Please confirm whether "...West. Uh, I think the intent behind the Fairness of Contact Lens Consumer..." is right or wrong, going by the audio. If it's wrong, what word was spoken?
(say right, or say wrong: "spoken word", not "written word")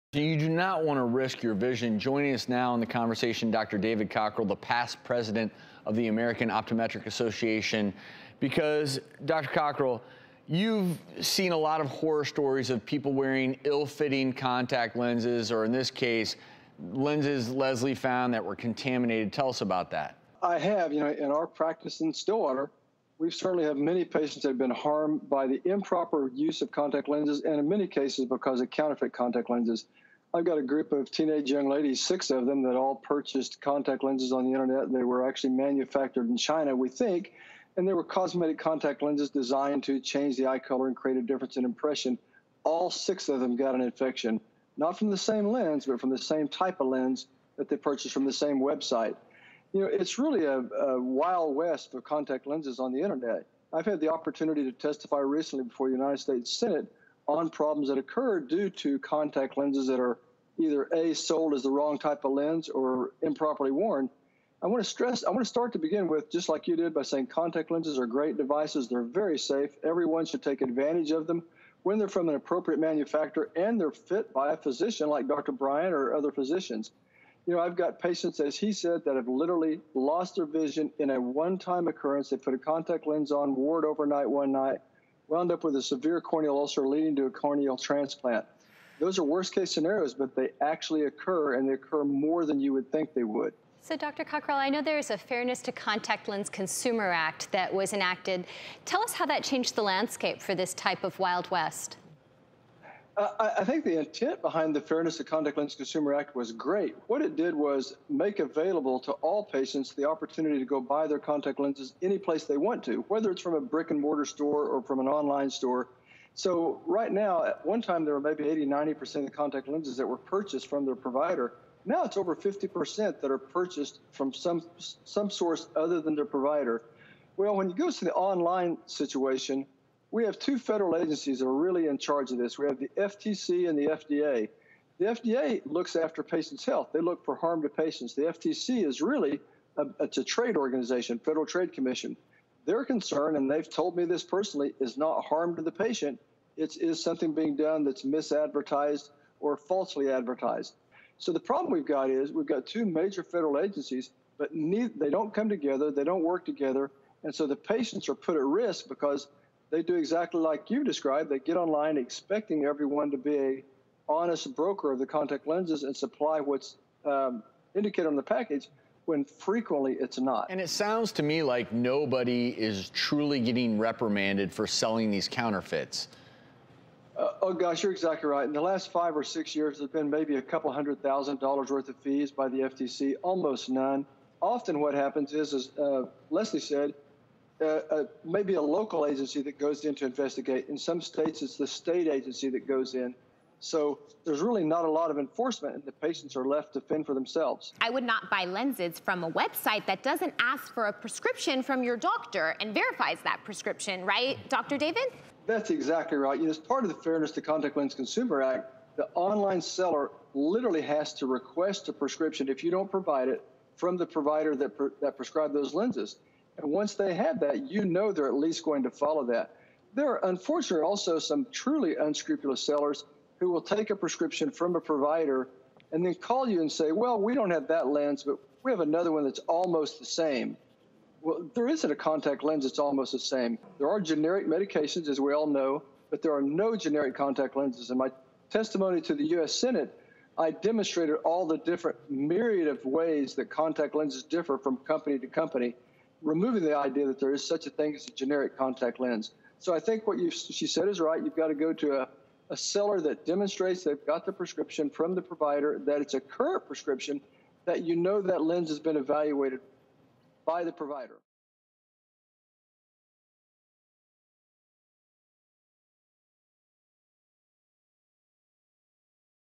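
right.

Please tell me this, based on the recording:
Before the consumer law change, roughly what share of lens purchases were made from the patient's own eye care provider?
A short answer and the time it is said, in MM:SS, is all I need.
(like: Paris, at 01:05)
80 to 90%, at 01:58.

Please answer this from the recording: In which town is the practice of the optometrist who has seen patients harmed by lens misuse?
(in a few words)
Stillwater.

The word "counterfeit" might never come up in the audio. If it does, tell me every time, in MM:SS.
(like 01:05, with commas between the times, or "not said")
00:28, 02:55.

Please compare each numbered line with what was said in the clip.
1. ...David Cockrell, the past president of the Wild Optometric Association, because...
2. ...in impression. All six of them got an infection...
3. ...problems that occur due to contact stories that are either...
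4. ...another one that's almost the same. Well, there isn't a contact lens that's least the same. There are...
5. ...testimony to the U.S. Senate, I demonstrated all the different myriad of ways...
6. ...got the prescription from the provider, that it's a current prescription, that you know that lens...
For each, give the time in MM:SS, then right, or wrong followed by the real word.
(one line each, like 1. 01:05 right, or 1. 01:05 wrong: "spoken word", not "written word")
1. 00:03 wrong: "American", not "Wild"
2. 00:41 right
3. 00:57 wrong: "lenses", not "stories"
4. 03:48 wrong: "almost", not "least"
5. 03:58 right
6. 04:14 right.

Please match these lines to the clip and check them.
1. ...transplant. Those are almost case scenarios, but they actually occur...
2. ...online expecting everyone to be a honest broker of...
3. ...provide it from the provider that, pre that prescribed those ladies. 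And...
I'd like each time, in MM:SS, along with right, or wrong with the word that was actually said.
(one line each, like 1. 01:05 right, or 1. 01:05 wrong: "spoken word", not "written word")
1. 01:27 wrong: "worst", not "almost"
2. 02:41 right
3. 03:32 wrong: "lenses", not "ladies".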